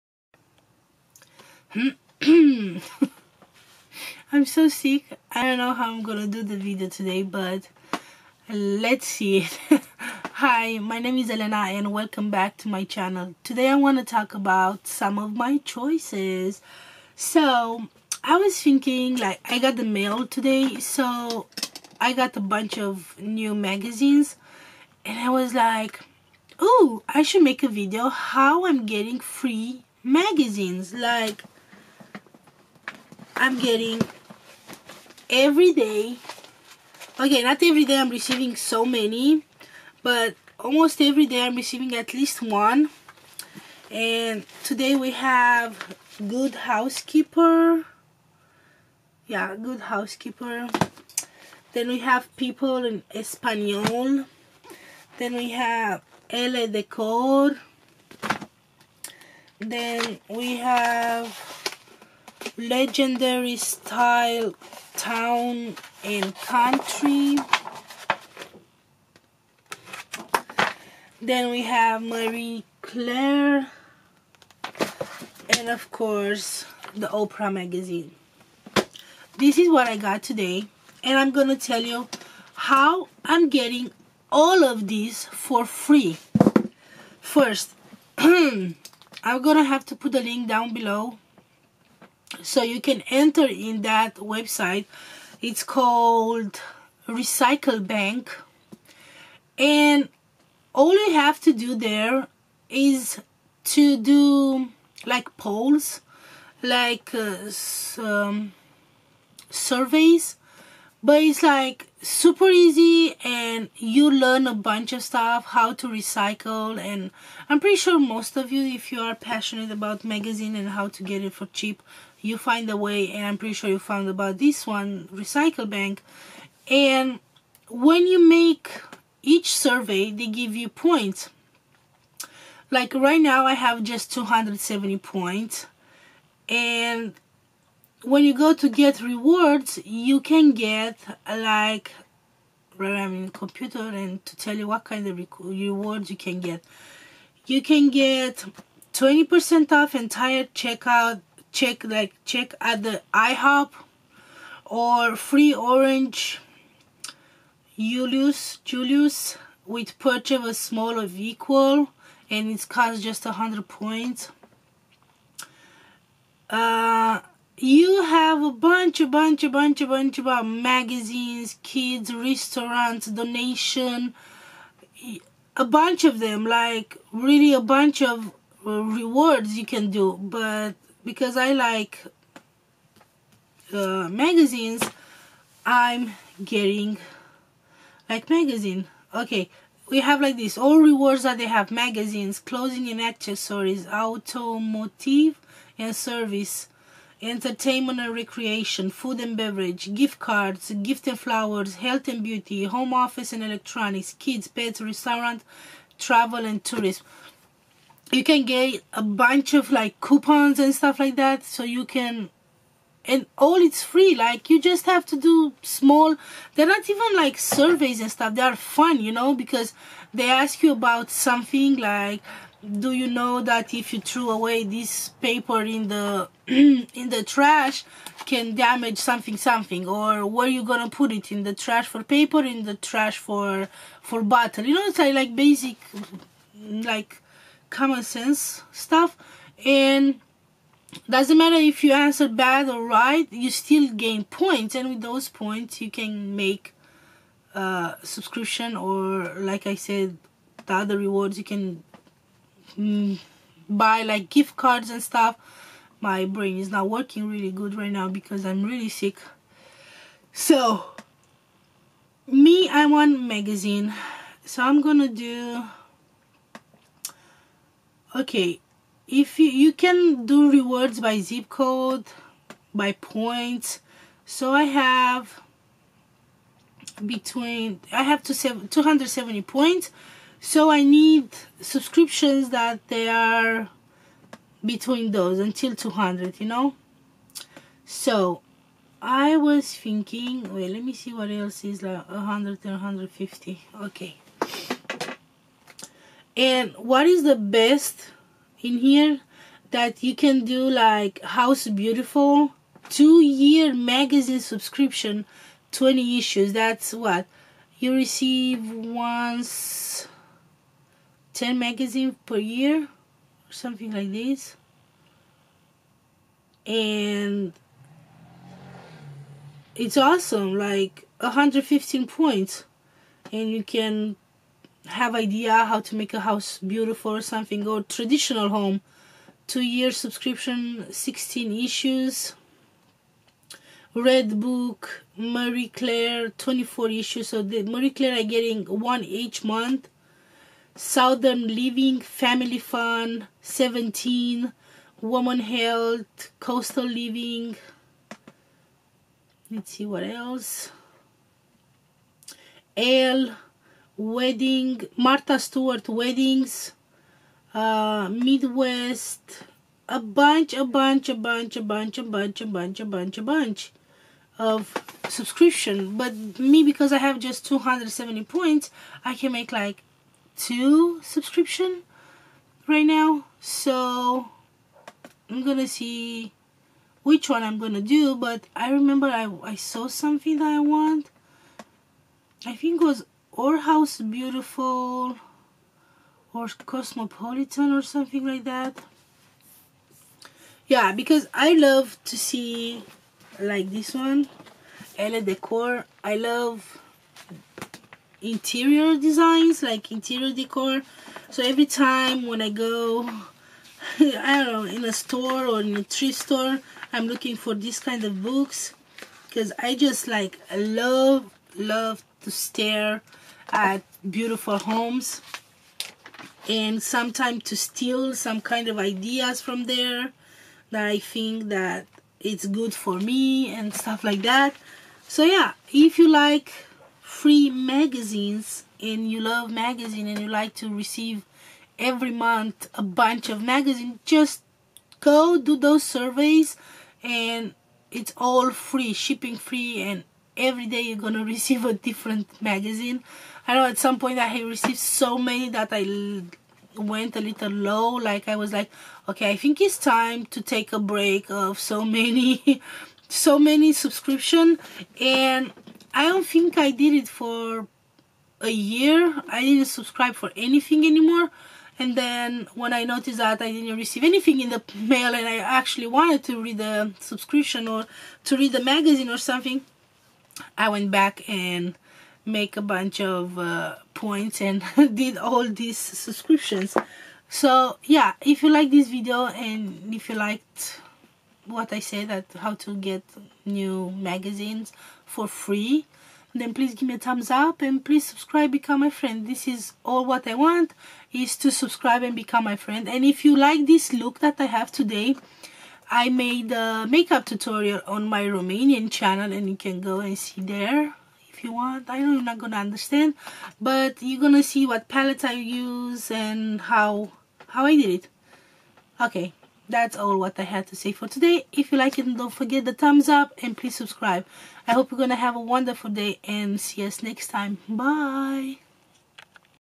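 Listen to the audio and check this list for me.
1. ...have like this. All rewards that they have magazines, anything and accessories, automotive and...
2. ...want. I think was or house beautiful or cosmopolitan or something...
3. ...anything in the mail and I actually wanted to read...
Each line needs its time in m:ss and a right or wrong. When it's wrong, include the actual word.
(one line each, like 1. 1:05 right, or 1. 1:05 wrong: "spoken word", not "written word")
1. 3:10 wrong: "clothing", not "anything"
2. 6:20 right
3. 7:44 right.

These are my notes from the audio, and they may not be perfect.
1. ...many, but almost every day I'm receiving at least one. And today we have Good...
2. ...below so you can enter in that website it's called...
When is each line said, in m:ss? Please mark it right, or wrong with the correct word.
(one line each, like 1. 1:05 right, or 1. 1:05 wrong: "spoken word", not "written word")
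1. 0:38 right
2. 1:30 right.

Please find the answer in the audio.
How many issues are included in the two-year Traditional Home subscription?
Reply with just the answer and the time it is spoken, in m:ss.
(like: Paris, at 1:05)
16, at 5:30.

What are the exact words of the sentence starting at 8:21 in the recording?
I know you're not gonna understand, but you're gonna see what palettes I use and how how I did it.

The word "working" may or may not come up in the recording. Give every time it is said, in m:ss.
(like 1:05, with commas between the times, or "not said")
4:16.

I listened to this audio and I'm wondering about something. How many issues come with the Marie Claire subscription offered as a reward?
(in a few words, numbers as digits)
24.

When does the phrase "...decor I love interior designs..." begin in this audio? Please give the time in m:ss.
6:35.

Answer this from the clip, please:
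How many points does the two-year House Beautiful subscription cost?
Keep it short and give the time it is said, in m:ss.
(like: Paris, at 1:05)
115, at 5:21.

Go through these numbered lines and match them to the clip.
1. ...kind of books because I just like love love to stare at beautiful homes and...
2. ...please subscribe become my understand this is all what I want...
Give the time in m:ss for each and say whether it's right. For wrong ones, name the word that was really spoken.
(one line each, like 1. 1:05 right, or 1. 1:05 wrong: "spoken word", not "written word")
1. 6:47 right
2. 8:07 wrong: "friend", not "understand".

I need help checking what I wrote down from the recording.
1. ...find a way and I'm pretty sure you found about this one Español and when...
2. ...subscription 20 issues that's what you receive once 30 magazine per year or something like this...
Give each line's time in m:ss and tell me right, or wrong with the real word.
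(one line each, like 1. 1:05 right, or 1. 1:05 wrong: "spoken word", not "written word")
1. 2:02 wrong: "Recyclebank", not "Español"
2. 5:04 wrong: "10", not "30".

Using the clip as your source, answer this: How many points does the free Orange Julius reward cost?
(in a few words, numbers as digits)
100.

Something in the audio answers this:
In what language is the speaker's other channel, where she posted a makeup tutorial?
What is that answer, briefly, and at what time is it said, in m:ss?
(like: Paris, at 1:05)
Romanian, at 8:18.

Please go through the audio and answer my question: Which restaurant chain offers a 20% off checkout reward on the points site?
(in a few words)
IHOP.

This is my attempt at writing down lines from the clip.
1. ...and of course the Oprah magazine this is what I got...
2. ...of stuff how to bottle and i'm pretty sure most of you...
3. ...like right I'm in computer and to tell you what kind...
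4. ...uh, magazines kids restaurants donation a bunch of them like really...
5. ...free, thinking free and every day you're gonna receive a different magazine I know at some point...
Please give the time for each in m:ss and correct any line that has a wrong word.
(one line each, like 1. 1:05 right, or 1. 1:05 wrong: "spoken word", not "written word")
1. 1:15 right
2. 1:54 wrong: "recycle", not "bottle"
3. 2:21 right
4. 2:50 right
5. 7:18 wrong: "shipping", not "thinking".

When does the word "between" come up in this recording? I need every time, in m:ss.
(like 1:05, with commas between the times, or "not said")
4:37, 4:44.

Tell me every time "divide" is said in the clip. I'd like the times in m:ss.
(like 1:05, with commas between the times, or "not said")
not said.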